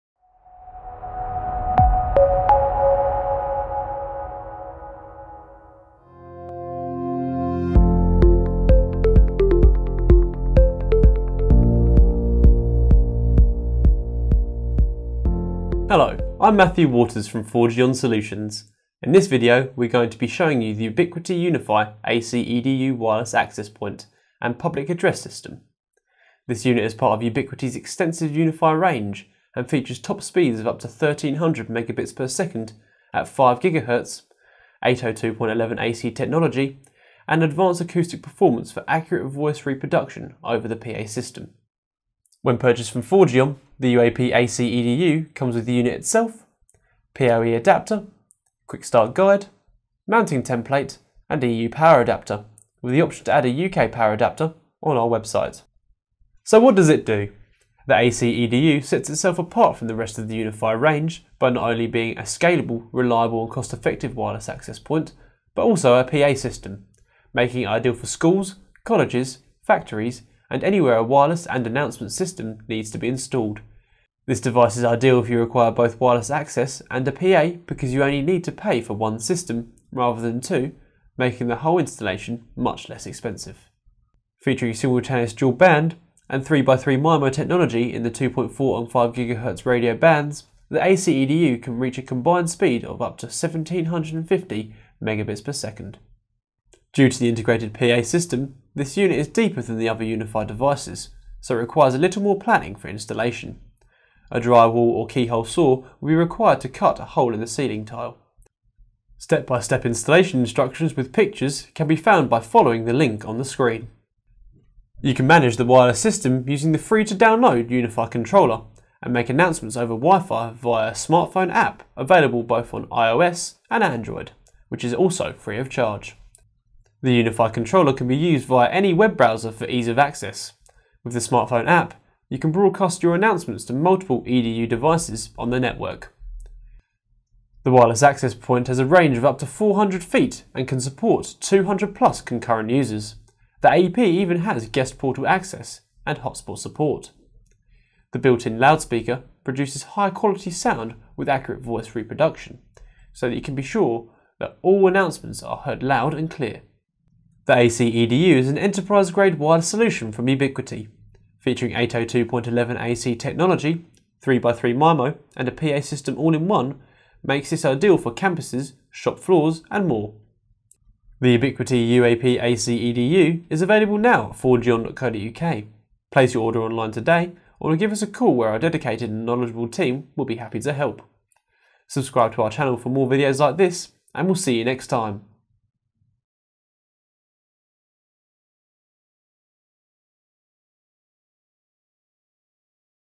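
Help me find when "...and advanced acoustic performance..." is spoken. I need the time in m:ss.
0:37.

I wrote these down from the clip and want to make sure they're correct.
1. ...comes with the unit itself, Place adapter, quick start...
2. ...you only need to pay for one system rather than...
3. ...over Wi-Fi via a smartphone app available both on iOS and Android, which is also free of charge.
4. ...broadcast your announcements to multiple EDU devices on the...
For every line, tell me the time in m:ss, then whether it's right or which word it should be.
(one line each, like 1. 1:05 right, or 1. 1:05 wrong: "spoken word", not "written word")
1. 0:45 wrong: "PoE", not "Place"
2. 1:17 right
3. 1:59 right
4. 2:12 right.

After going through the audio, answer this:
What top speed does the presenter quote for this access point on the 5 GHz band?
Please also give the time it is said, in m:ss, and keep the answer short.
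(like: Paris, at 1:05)
1300 megabits per second, at 0:30.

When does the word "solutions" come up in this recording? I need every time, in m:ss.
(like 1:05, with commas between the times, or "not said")
0:17, 2:39.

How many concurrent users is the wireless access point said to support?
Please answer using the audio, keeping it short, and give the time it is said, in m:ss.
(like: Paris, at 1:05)
200 plus, at 2:21.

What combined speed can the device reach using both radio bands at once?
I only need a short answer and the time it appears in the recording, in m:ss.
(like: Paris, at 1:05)
1750 megabits per second, at 1:33.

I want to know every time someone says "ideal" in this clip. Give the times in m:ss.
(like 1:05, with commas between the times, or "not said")
1:07, 1:14, 2:47.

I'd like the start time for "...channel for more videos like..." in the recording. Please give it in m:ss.
3:02.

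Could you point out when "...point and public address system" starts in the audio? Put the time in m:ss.
0:23.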